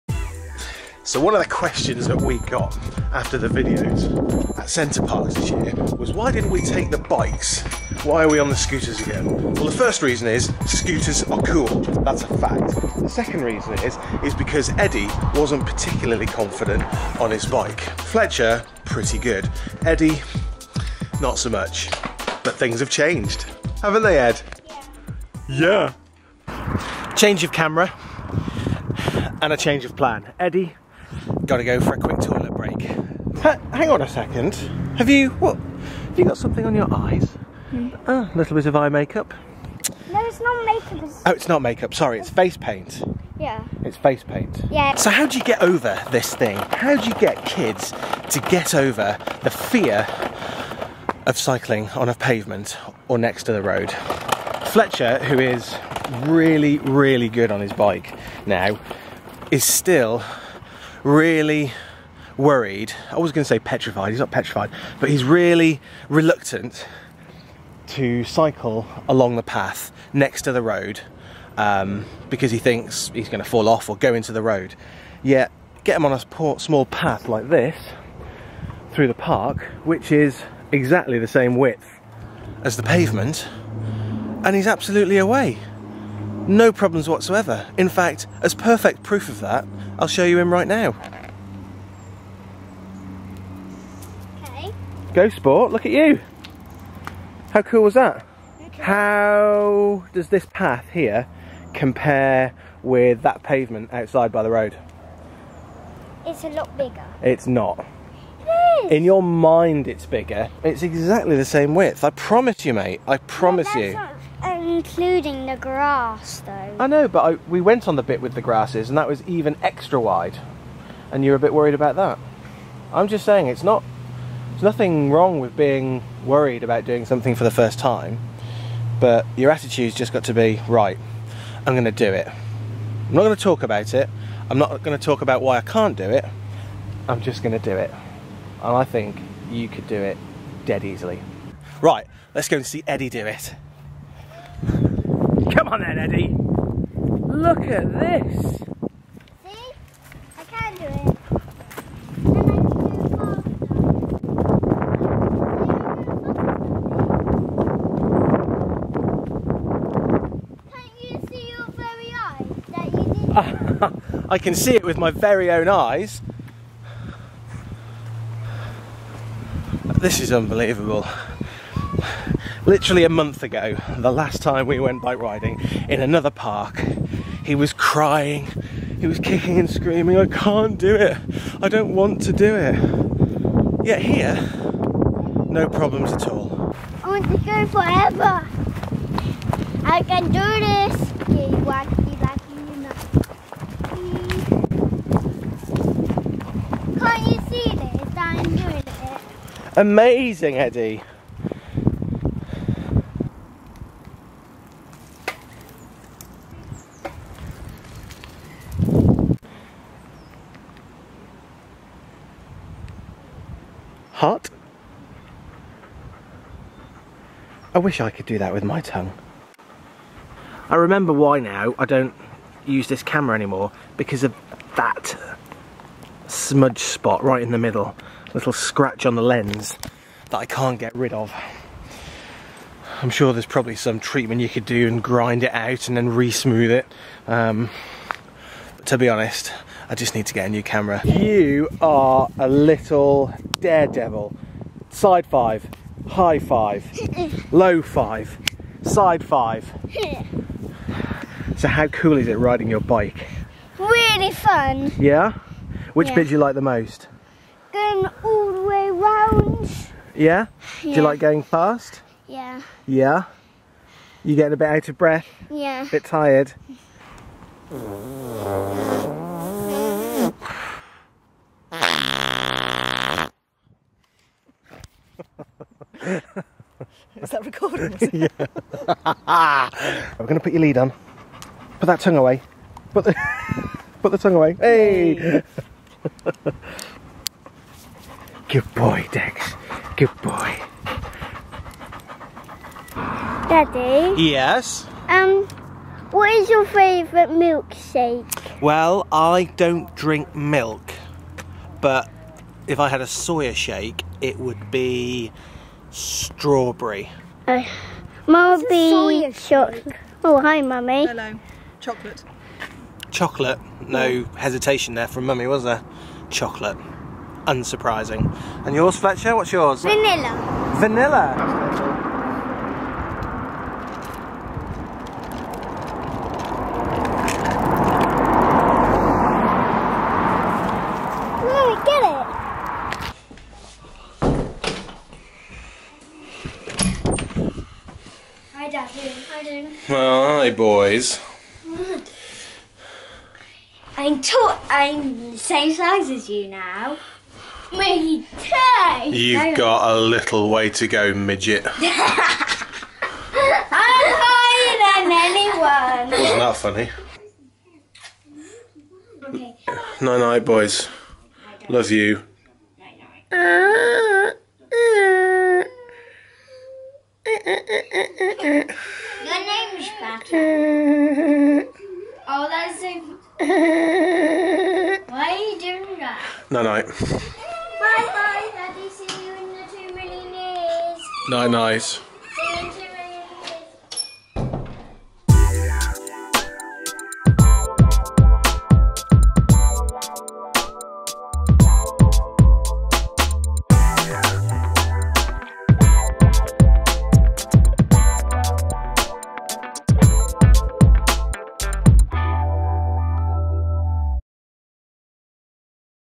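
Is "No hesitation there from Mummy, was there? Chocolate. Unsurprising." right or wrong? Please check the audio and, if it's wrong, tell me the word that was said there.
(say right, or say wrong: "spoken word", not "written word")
right.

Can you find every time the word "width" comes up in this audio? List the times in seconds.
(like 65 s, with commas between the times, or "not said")
81 s, 111 s.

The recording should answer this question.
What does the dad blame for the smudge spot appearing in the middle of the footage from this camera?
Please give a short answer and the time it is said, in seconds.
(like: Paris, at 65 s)
Little scratch on the lens, at 228 s.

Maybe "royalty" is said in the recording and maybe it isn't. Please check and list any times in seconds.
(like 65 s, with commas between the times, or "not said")
not said.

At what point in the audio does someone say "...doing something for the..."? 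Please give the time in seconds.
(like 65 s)
126 s.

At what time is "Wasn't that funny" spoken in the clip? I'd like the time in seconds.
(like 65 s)
356 s.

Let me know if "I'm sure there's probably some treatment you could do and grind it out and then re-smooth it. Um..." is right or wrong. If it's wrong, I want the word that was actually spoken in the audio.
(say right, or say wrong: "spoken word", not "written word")
right.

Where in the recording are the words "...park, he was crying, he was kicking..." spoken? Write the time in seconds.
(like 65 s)
176 s.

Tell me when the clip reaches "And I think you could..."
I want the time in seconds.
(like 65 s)
138 s.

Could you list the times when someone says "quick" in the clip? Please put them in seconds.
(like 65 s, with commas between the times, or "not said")
31 s.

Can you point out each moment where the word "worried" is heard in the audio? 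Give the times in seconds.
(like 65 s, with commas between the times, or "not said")
62 s, 121 s, 126 s.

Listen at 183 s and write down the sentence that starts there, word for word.
Yet here, no problems at all.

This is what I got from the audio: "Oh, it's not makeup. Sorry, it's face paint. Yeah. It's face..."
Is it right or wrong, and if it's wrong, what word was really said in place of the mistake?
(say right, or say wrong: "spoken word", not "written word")
right.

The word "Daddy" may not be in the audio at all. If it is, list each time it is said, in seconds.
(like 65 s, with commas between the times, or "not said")
293 s, 378 s.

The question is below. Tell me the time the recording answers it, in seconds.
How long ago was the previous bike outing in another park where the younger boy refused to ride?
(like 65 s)
173 s.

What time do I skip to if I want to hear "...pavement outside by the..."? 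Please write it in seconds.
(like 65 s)
103 s.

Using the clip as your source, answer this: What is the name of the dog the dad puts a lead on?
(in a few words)
Dex.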